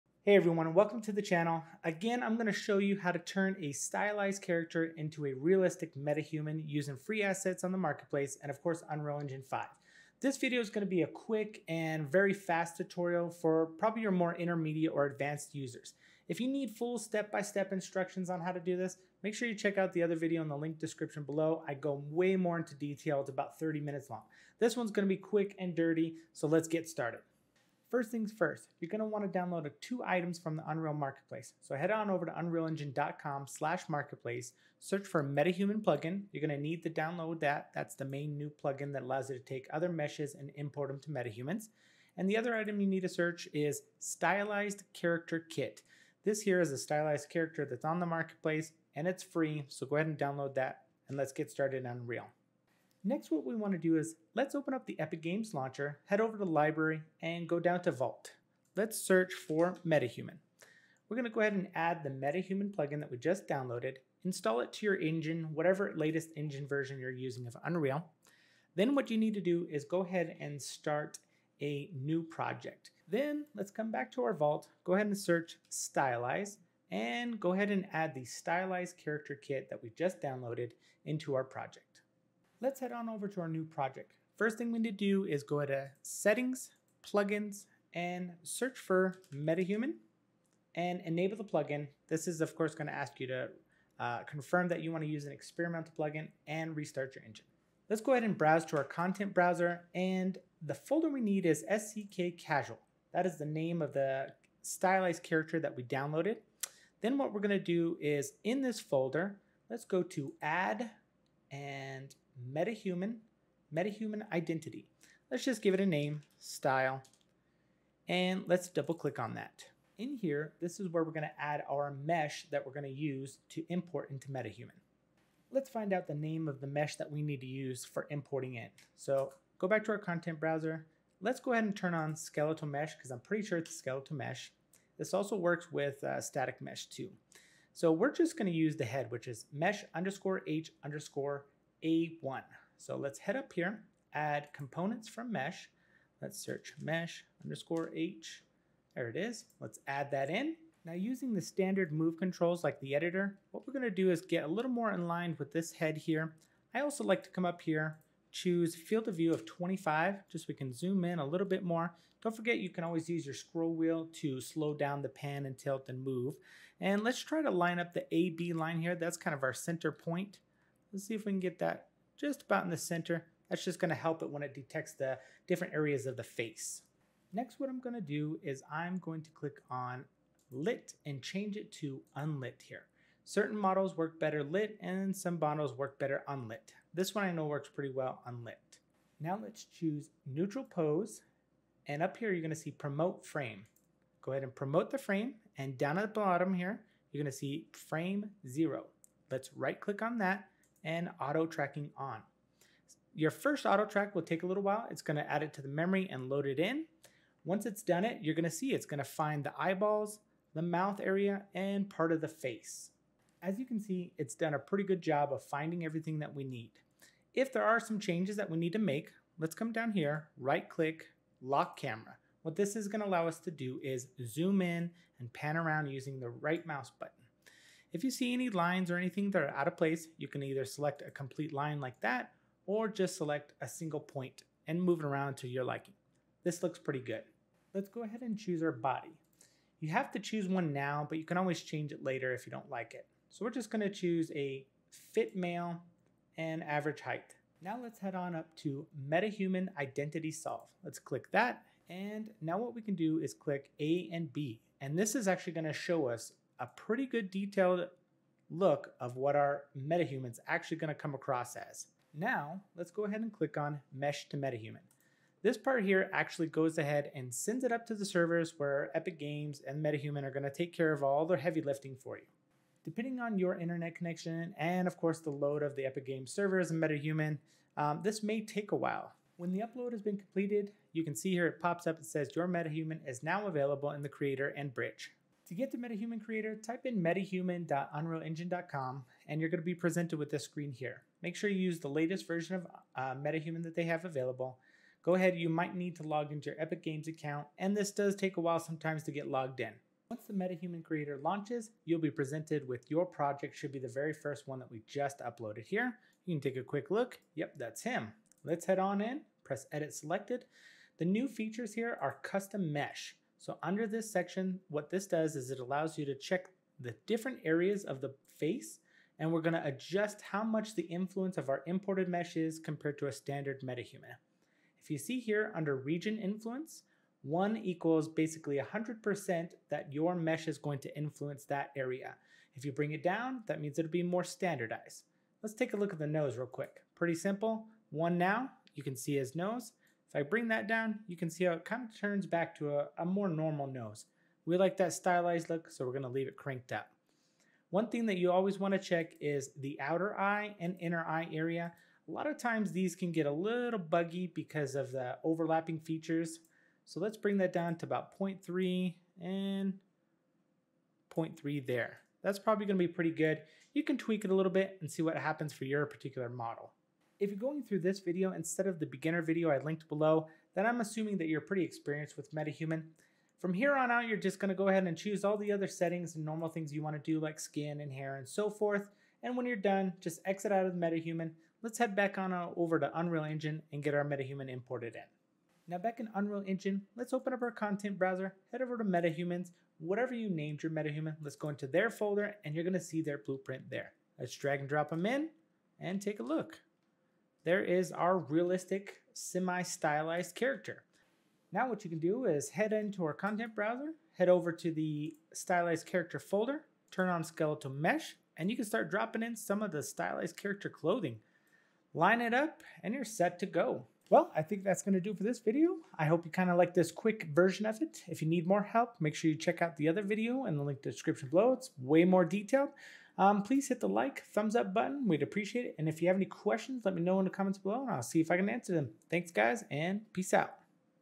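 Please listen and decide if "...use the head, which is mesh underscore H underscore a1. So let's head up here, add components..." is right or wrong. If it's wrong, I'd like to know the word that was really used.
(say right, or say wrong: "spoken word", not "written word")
right.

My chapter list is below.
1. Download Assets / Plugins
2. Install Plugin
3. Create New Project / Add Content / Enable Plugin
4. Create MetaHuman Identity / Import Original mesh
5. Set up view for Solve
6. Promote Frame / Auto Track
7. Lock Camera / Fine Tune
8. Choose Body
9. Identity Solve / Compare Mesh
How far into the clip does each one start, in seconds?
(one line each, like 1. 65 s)
1. 27 s
2. 52 s
3. 74 s
4. 105 s
5. 150 s
6. 177 s
7. 220 s
8. 237 s
9. 248 s.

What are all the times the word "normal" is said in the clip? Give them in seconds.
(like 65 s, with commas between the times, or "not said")
343 s, 376 s.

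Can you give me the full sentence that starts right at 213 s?
As you can see, it's done a pretty good job of finding everything that we need.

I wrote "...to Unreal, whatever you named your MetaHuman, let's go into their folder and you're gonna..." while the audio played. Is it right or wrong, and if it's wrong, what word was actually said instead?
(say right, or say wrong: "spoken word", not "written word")
wrong: "MetaHumans", not "Unreal".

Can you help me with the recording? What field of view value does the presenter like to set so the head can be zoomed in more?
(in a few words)
25.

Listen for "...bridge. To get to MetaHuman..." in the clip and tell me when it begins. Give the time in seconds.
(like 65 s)
284 s.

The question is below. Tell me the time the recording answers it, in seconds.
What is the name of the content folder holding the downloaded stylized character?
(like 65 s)
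101 s.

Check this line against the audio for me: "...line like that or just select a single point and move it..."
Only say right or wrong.
right.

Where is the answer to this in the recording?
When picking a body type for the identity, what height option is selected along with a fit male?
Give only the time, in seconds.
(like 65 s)
246 s.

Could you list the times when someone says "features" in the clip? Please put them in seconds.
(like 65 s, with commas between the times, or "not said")
311 s, 355 s.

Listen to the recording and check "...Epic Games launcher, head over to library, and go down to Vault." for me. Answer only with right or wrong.
right.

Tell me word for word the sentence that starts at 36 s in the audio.
You're gonna need to download that.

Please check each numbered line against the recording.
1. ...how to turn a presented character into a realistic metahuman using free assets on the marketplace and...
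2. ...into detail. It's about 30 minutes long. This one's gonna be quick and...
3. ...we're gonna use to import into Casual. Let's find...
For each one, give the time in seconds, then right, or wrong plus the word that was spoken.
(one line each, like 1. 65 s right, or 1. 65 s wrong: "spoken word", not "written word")
1. 2 s wrong: "stylized", not "presented"
2. 22 s right
3. 122 s wrong: "MetaHuman", not "Casual".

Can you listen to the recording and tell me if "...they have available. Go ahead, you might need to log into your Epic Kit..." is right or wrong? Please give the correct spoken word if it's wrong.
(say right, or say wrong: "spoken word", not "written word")
wrong: "Games", not "Kit".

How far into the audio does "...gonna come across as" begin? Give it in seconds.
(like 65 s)
260 s.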